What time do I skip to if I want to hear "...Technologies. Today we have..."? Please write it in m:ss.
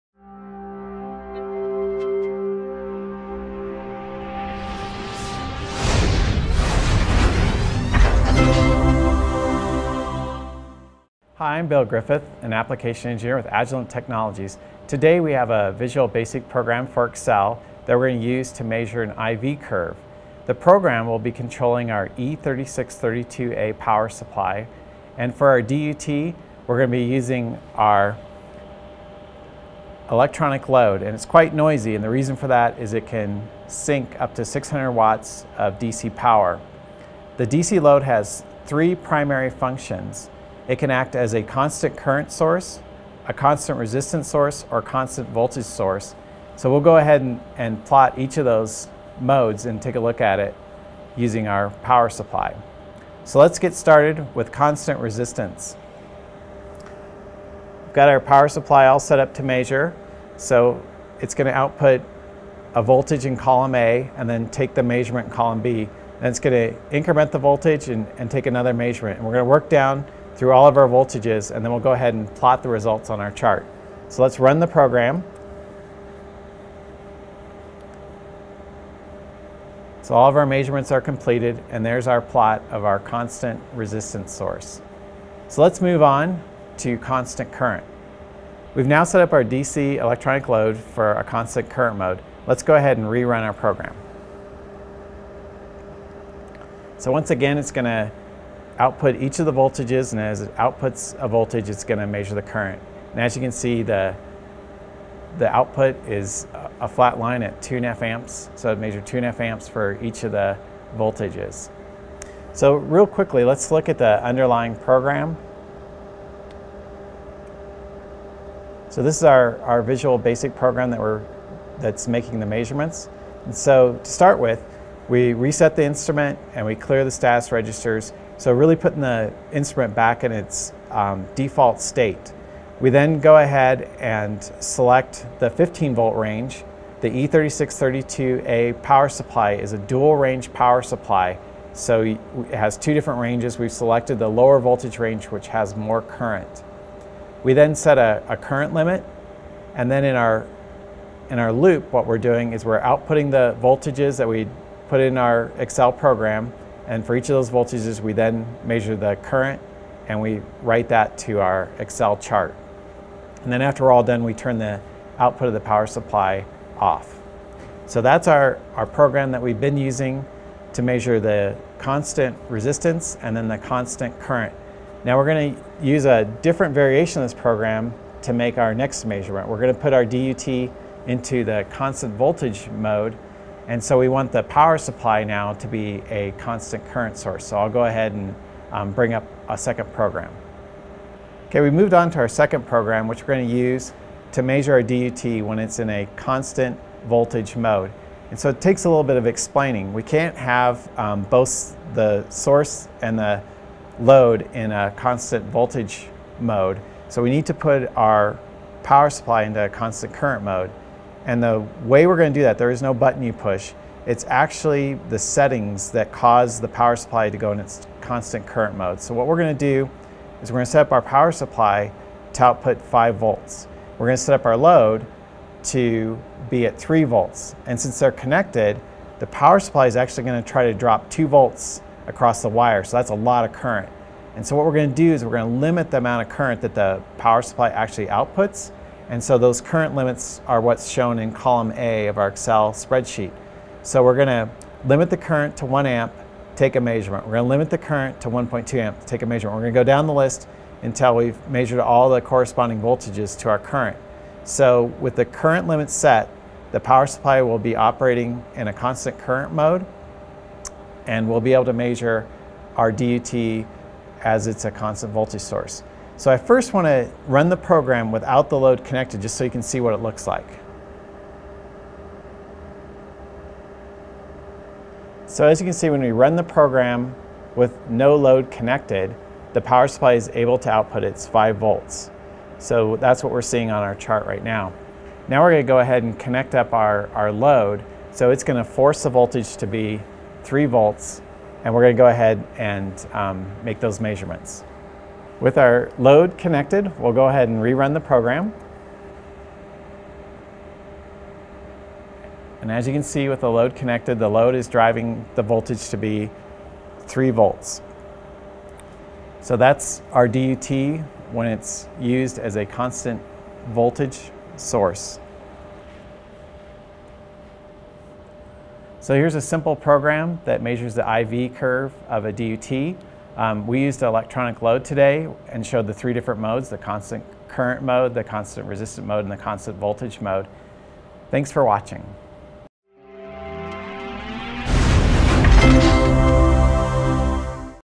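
0:13.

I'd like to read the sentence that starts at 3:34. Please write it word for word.
It's actually the settings that cause the power supply to go in its constant current mode.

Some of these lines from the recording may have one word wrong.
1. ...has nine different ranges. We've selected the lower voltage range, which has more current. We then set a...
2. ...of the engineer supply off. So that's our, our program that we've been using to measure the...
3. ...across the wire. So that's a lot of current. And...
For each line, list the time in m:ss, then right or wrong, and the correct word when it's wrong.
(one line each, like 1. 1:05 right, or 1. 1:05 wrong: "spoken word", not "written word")
1. 2:22 wrong: "two", not "nine"
2. 2:45 wrong: "power", not "engineer"
3. 3:52 right.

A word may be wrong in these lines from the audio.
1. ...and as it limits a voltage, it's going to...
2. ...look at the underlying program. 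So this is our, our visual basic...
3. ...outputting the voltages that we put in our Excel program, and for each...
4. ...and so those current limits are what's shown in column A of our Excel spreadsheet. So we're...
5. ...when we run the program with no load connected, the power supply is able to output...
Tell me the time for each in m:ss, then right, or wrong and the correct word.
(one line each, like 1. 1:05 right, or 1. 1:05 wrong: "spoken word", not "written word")
1. 1:40 wrong: "outputs", not "limits"
2. 1:53 right
3. 2:32 right
4. 3:59 right
5. 4:35 right.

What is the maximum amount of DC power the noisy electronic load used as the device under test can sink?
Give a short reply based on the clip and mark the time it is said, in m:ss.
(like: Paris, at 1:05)
600 watts, at 0:34.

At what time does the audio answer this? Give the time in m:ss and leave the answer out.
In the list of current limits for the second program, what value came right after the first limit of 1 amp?
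4:08.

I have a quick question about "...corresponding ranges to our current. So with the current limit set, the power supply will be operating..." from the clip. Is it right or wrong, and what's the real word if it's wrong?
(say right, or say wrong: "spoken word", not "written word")
wrong: "voltages", not "ranges".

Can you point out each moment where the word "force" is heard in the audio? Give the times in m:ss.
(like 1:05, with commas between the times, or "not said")
4:48.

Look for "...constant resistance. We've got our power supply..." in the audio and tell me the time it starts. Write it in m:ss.
0:54.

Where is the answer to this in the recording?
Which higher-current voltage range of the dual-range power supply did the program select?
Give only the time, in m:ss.
2:15.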